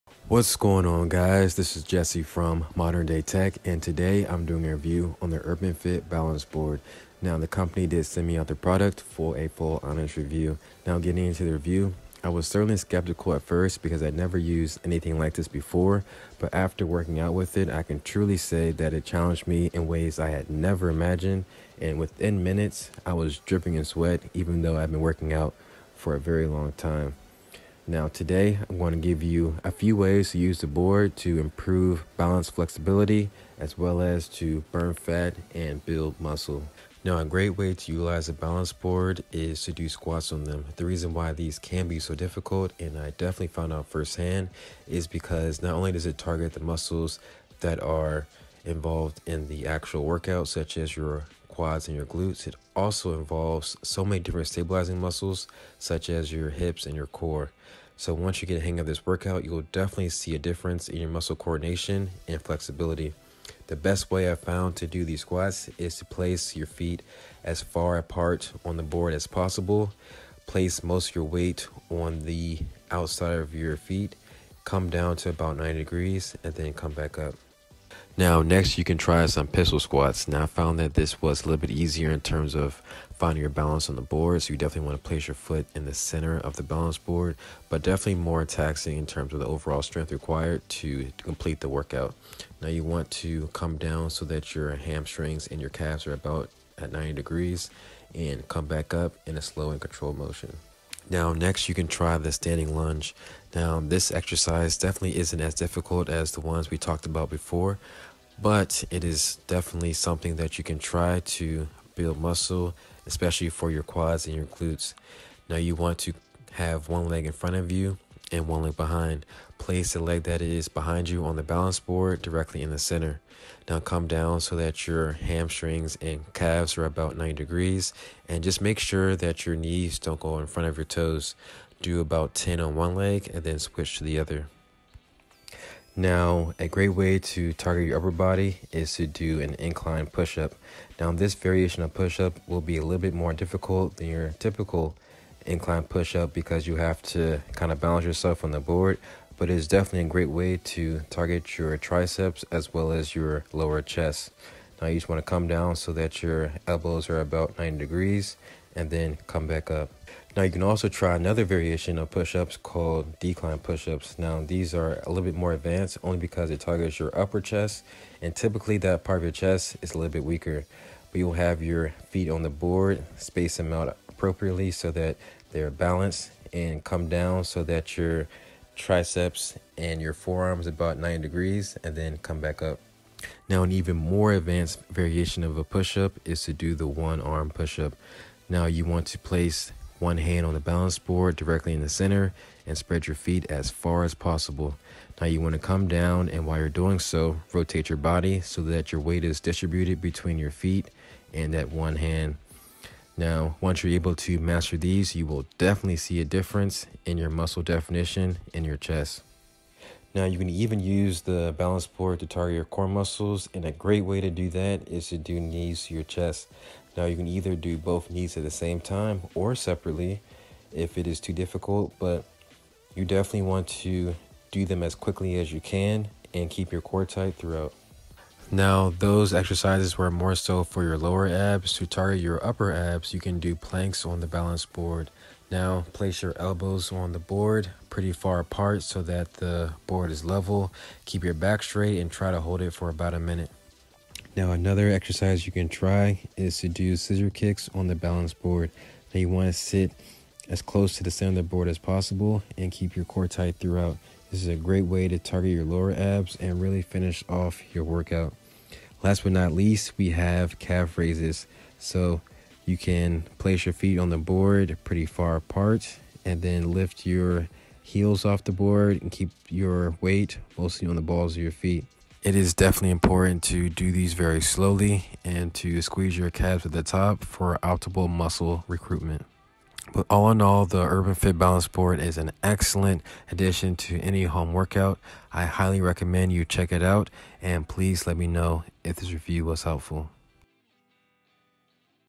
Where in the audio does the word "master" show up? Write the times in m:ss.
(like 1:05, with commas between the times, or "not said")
3:24.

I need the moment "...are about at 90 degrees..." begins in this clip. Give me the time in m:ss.
1:36.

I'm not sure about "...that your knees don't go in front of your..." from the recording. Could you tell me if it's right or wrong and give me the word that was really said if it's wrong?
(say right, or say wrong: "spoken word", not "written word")
right.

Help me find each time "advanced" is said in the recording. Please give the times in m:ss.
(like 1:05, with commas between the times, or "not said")
2:45, 3:04.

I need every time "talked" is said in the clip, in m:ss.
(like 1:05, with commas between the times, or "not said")
1:46.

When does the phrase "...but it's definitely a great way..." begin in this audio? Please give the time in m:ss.
2:29.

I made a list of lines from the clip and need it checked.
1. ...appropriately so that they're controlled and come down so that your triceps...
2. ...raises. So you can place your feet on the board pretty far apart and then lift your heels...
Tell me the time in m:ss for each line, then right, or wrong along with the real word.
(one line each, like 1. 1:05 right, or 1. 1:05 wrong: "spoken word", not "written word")
1. 2:54 wrong: "balanced", not "controlled"
2. 4:20 right.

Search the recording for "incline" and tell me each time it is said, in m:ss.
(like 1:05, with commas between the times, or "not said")
2:19, 2:25.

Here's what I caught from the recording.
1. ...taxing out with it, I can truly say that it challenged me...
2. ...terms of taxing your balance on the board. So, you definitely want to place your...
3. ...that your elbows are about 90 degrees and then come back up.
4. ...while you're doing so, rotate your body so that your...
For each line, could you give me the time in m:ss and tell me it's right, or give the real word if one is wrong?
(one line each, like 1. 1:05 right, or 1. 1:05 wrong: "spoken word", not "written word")
1. 0:16 wrong: "working", not "taxing"
2. 1:22 wrong: "finding", not "taxing"
3. 2:35 right
4. 3:16 right.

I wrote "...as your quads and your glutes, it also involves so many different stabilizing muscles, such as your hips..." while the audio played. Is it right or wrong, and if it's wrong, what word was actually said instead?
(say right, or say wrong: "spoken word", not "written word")
right.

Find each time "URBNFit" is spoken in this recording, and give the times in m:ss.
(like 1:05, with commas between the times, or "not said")
0:05, 4:40.